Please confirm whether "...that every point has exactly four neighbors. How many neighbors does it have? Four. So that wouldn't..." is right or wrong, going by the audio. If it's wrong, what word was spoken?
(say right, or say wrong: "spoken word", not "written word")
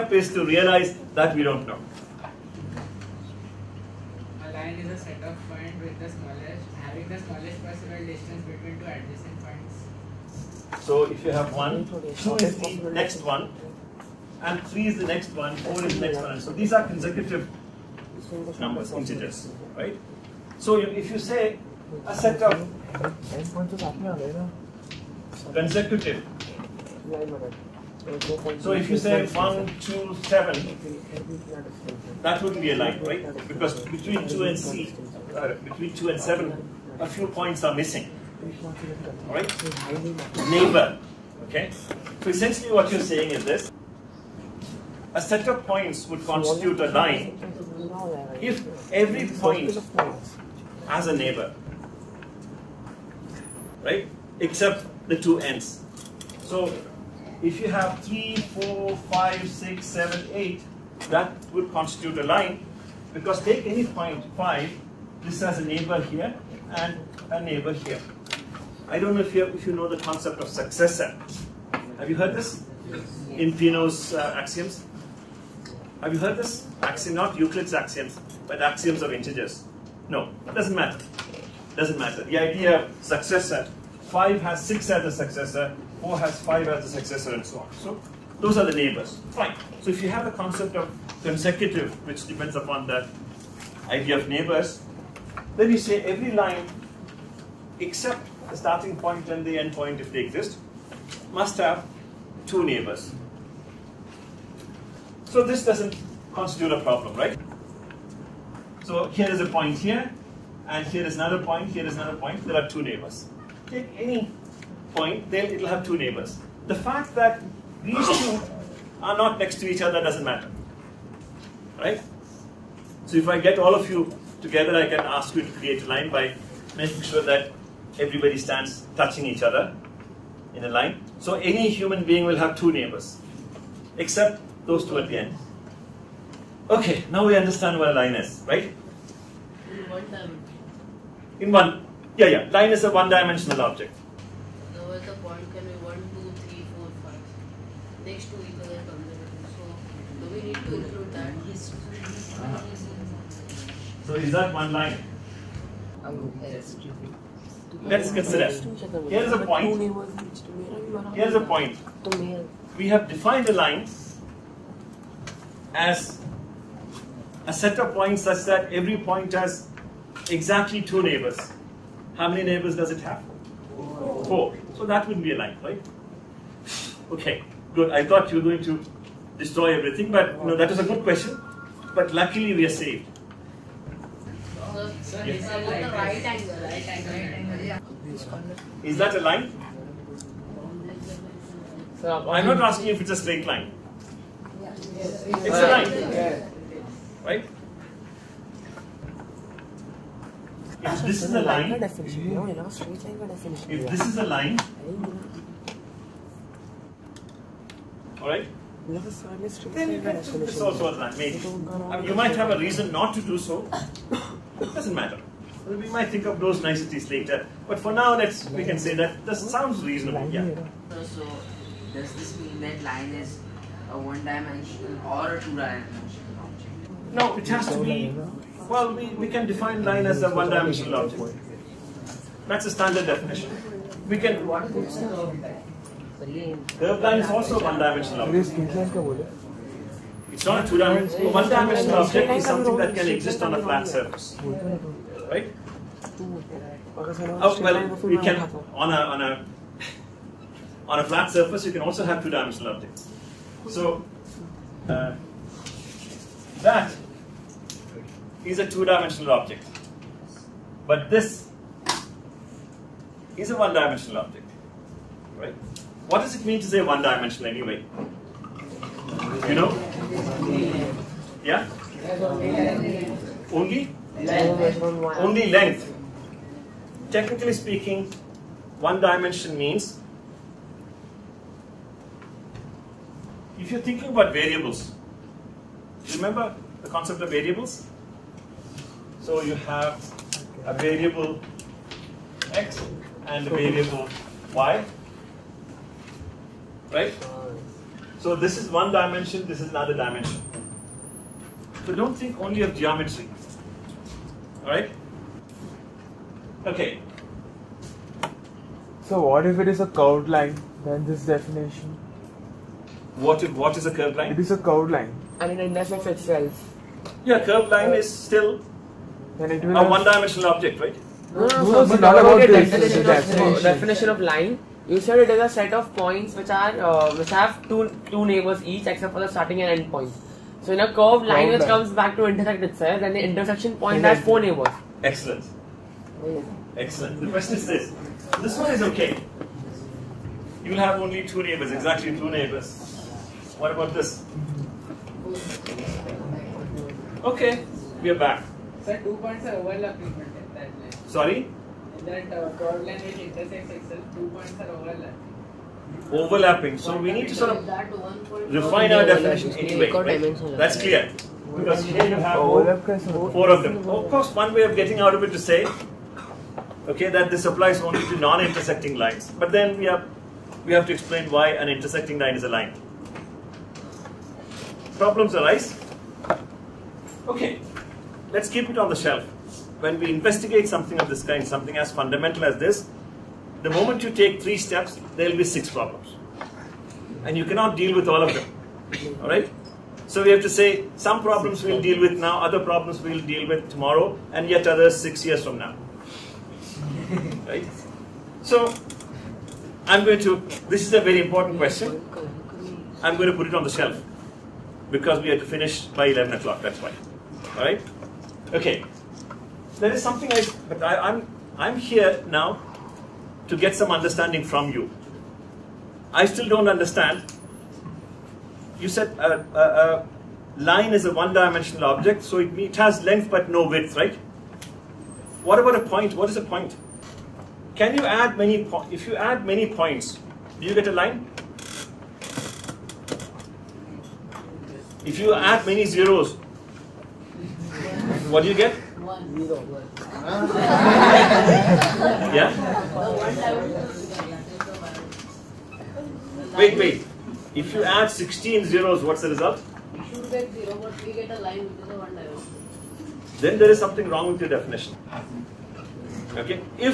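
wrong: "two", not "four".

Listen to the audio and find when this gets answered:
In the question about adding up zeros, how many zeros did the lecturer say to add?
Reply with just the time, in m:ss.
7:28.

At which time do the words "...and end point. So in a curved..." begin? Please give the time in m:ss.
5:29.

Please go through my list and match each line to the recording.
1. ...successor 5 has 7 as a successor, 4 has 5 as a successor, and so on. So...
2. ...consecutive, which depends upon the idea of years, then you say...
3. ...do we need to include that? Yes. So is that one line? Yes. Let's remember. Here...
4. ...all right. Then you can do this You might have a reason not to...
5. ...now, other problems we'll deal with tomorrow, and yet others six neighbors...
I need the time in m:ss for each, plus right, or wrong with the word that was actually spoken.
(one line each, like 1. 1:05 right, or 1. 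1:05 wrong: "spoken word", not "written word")
1. 1:23 wrong: "6", not "7"
2. 1:31 wrong: "neighbors", not "years"
3. 2:30 wrong: "consider", not "remember"
4. 3:28 right
5. 6:32 wrong: "years", not "neighbors".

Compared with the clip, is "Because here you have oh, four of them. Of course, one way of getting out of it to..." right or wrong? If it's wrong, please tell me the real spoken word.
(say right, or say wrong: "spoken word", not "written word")
right.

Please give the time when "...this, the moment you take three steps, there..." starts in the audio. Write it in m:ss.
6:22.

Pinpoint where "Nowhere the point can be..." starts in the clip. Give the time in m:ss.
2:24.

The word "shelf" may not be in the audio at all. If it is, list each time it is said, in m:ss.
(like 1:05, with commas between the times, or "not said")
6:18, 6:43.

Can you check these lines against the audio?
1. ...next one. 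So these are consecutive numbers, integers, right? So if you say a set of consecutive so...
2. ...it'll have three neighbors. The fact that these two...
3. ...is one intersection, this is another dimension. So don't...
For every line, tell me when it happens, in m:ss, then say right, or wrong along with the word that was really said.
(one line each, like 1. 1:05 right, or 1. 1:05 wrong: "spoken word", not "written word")
1. 0:16 right
2. 1:55 wrong: "two", not "three"
3. 4:58 wrong: "dimension", not "intersection".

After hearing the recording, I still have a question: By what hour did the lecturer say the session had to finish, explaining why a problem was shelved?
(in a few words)
11 o'clock.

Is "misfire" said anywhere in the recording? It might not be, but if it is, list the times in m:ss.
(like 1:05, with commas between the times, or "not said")
not said.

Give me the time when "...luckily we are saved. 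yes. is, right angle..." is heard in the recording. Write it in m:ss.
3:02.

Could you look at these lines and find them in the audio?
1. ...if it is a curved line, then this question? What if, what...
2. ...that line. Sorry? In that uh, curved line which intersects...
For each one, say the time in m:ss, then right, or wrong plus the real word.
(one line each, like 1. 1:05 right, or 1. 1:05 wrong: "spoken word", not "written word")
1. 5:09 wrong: "definition", not "question"
2. 5:50 right.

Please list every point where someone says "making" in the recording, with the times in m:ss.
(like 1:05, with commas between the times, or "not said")
2:06.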